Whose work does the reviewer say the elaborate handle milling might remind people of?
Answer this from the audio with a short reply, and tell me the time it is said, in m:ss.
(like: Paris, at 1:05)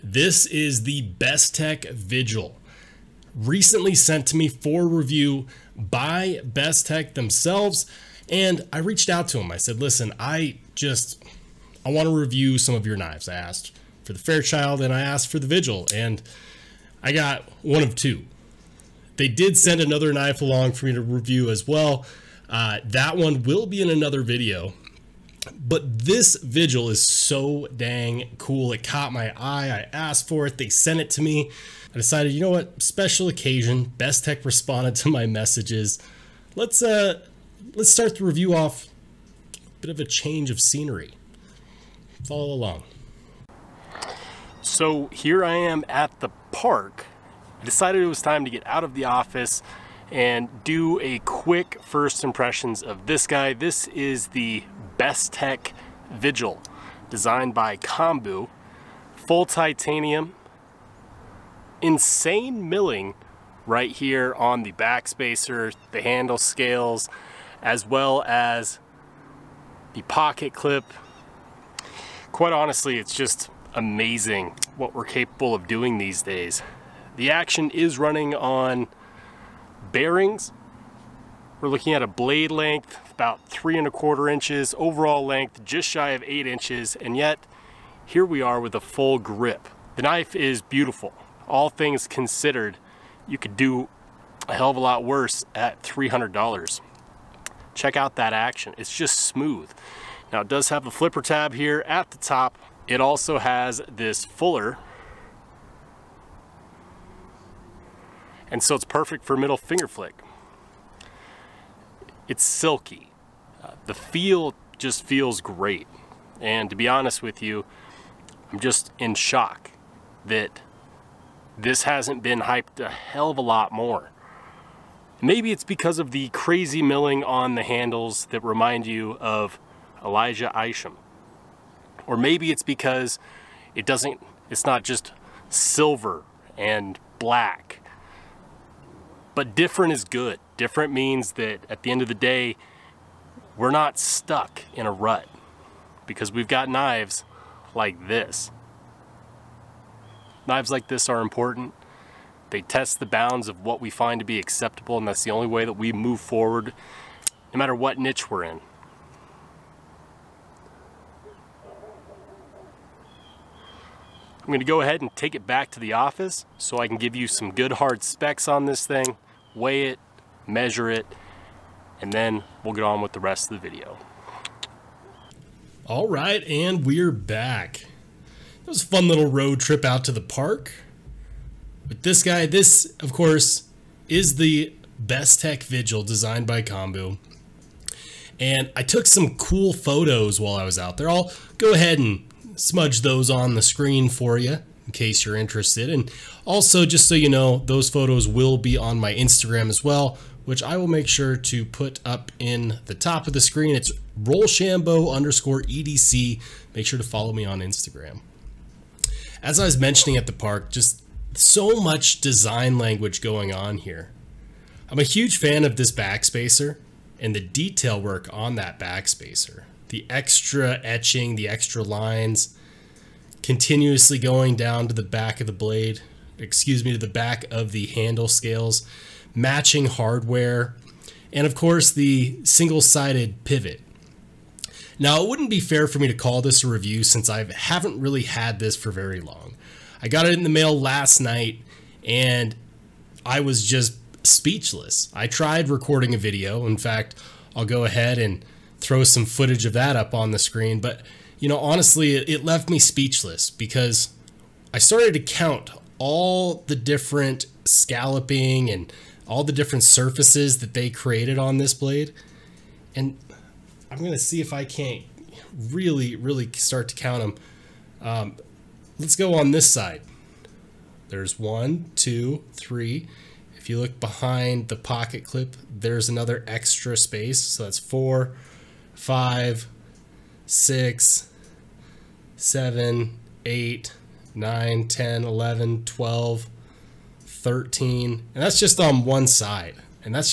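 Elijah Isham, at 2:10.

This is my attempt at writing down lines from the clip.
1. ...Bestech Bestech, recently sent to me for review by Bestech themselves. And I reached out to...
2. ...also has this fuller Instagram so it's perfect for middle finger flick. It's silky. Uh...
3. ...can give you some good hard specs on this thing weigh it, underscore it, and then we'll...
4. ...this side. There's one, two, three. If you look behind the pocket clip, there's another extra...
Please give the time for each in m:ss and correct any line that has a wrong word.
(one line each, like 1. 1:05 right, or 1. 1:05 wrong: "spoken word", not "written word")
1. 0:01 wrong: "Vigil", not "Bestech"
2. 1:42 wrong: "And", not "Instagram"
3. 2:46 wrong: "measure", not "underscore"
4. 4:29 right.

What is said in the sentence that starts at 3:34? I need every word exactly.
I'm a huge fan of this backspacer and the detail work on that backspacer.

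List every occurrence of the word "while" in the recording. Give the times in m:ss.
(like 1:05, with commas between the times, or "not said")
3:10.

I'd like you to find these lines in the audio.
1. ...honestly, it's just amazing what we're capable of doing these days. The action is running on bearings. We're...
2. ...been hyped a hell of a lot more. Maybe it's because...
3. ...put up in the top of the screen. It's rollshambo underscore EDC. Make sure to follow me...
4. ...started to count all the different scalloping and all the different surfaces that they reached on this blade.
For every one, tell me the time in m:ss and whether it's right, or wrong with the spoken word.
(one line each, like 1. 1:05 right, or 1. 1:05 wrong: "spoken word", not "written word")
1. 1:12 right
2. 2:02 right
3. 3:21 right
4. 4:14 wrong: "created", not "reached".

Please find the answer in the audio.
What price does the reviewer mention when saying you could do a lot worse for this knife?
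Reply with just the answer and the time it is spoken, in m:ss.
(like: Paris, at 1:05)
$300, at 1:35.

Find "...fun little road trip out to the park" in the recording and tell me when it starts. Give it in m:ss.
2:58.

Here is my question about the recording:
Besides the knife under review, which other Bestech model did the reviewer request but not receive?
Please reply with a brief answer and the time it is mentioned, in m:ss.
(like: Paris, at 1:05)
Fairchild, at 0:14.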